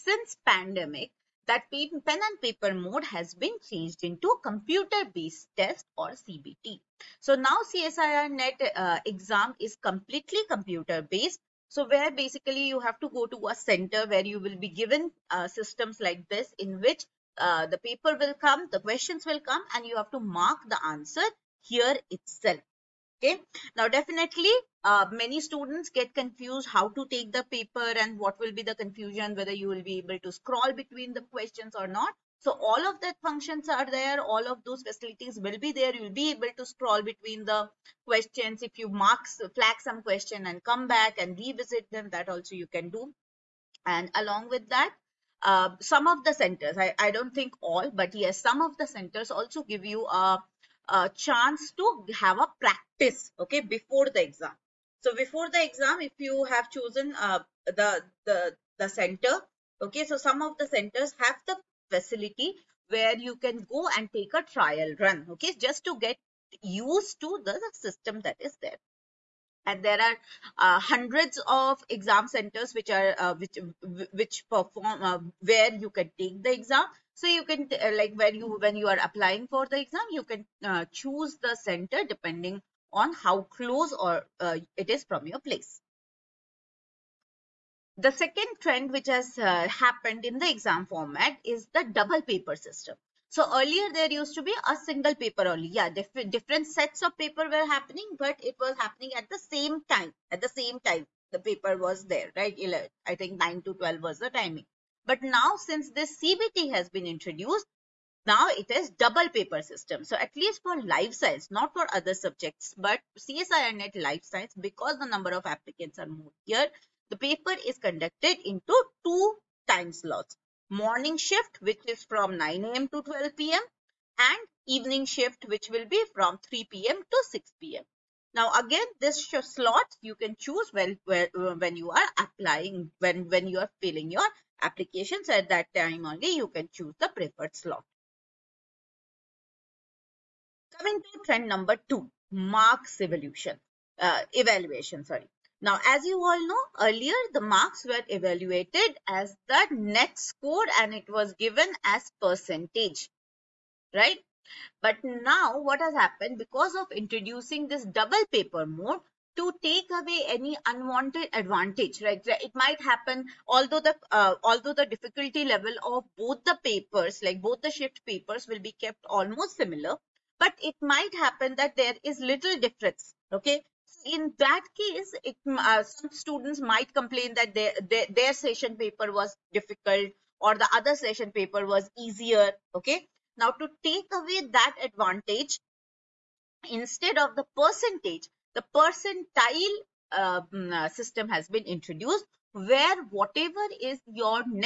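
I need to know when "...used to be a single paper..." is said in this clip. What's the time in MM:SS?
01:34.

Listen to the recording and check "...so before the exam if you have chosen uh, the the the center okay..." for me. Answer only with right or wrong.
right.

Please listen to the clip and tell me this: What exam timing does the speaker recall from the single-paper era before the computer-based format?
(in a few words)
9 to 12.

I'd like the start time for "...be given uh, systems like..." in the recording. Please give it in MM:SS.
00:14.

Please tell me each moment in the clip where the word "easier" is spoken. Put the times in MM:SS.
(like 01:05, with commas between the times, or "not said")
03:01.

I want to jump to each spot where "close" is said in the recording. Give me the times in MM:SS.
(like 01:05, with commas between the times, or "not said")
01:23.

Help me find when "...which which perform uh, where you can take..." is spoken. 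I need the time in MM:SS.
01:13.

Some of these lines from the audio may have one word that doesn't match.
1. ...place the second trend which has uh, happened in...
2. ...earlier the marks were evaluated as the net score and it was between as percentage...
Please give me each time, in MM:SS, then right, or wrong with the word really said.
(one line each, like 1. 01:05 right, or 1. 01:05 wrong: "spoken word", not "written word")
1. 01:25 right
2. 02:26 wrong: "given", not "between".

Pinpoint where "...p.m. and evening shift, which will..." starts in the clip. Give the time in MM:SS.
02:03.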